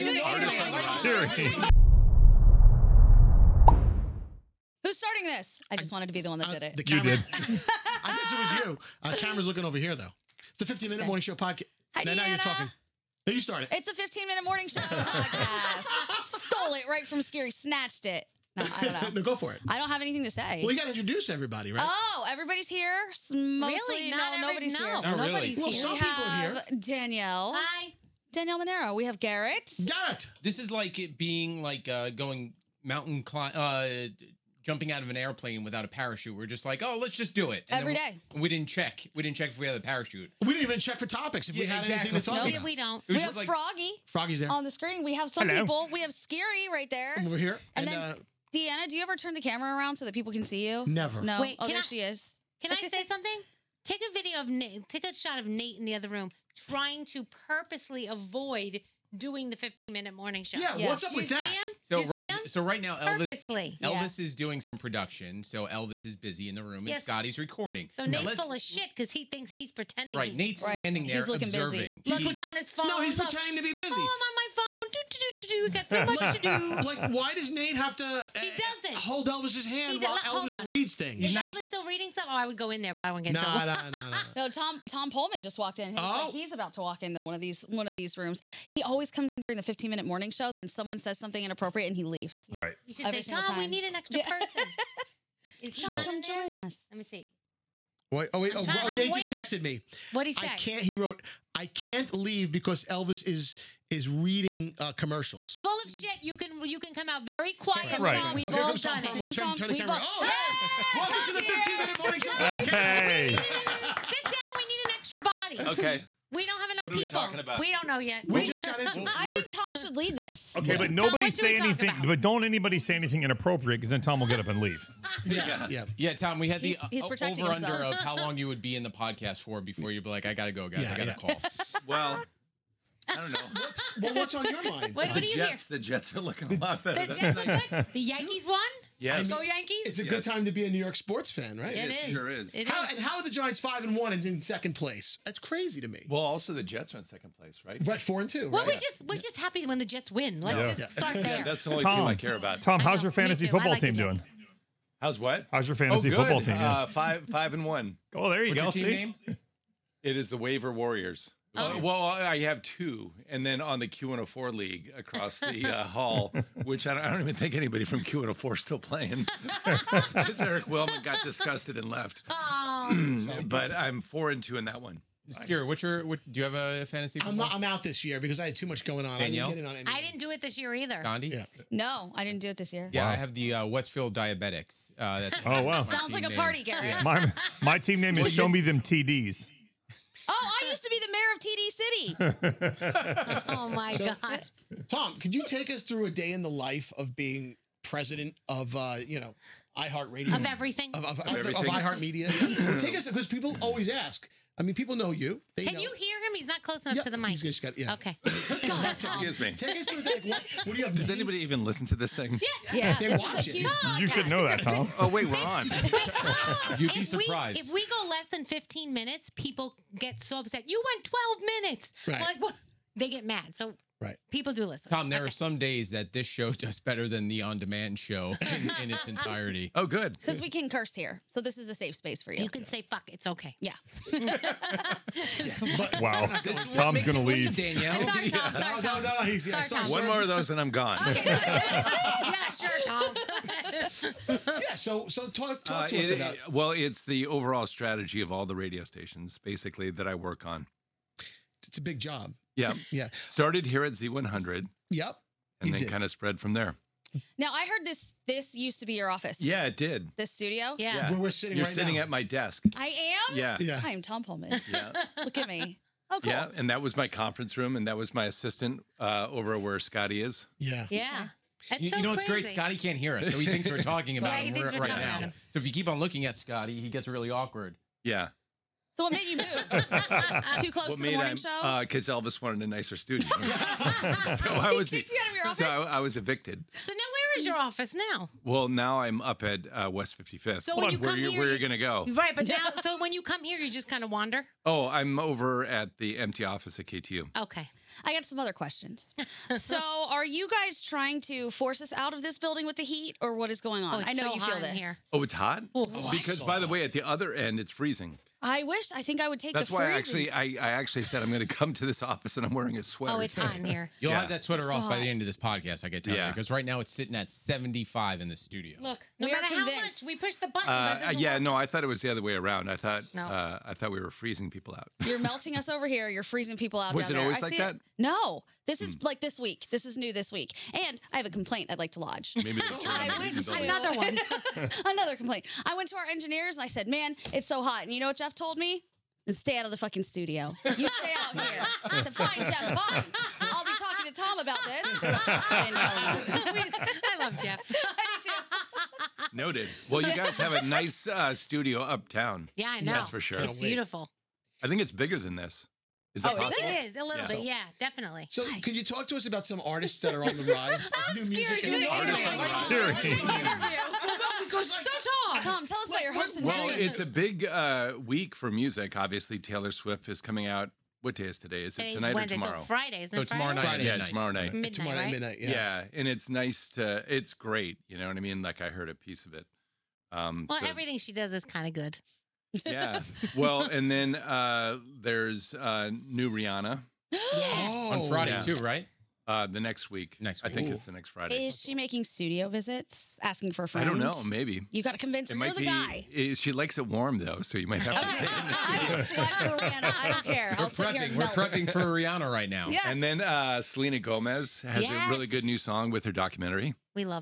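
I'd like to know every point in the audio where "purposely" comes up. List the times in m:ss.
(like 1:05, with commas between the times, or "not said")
0:57, 1:03.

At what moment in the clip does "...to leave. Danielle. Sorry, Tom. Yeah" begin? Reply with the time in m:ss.
3:57.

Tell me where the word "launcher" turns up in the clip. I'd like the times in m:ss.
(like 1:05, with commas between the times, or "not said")
not said.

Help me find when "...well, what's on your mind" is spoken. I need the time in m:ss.
2:13.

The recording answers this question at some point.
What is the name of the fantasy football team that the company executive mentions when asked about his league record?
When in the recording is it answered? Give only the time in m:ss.
2:40.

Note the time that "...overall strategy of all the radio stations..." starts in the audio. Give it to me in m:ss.
4:07.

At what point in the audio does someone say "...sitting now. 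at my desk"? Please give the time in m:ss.
4:21.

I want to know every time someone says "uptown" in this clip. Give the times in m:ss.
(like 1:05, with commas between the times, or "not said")
5:51.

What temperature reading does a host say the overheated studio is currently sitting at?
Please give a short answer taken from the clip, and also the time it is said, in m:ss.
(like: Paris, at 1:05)
75, at 5:17.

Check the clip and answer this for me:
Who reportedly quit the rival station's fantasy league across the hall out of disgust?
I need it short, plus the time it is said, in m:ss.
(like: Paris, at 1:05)
Eric Wilman, at 2:50.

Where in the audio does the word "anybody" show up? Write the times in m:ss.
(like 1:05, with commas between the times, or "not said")
2:02, 2:47, 3:31.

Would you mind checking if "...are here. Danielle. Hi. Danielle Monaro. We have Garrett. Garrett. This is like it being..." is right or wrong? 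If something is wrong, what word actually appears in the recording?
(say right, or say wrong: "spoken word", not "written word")
right.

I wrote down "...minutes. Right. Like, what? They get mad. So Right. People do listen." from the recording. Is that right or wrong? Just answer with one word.
right.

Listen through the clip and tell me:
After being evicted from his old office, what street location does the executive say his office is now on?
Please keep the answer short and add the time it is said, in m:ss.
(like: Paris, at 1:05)
West 55th, at 4:49.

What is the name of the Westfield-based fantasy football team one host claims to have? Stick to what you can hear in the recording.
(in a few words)
Westfield Diabetics.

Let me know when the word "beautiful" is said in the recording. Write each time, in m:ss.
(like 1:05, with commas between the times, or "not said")
5:53.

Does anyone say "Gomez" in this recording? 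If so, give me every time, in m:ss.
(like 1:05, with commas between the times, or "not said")
6:43.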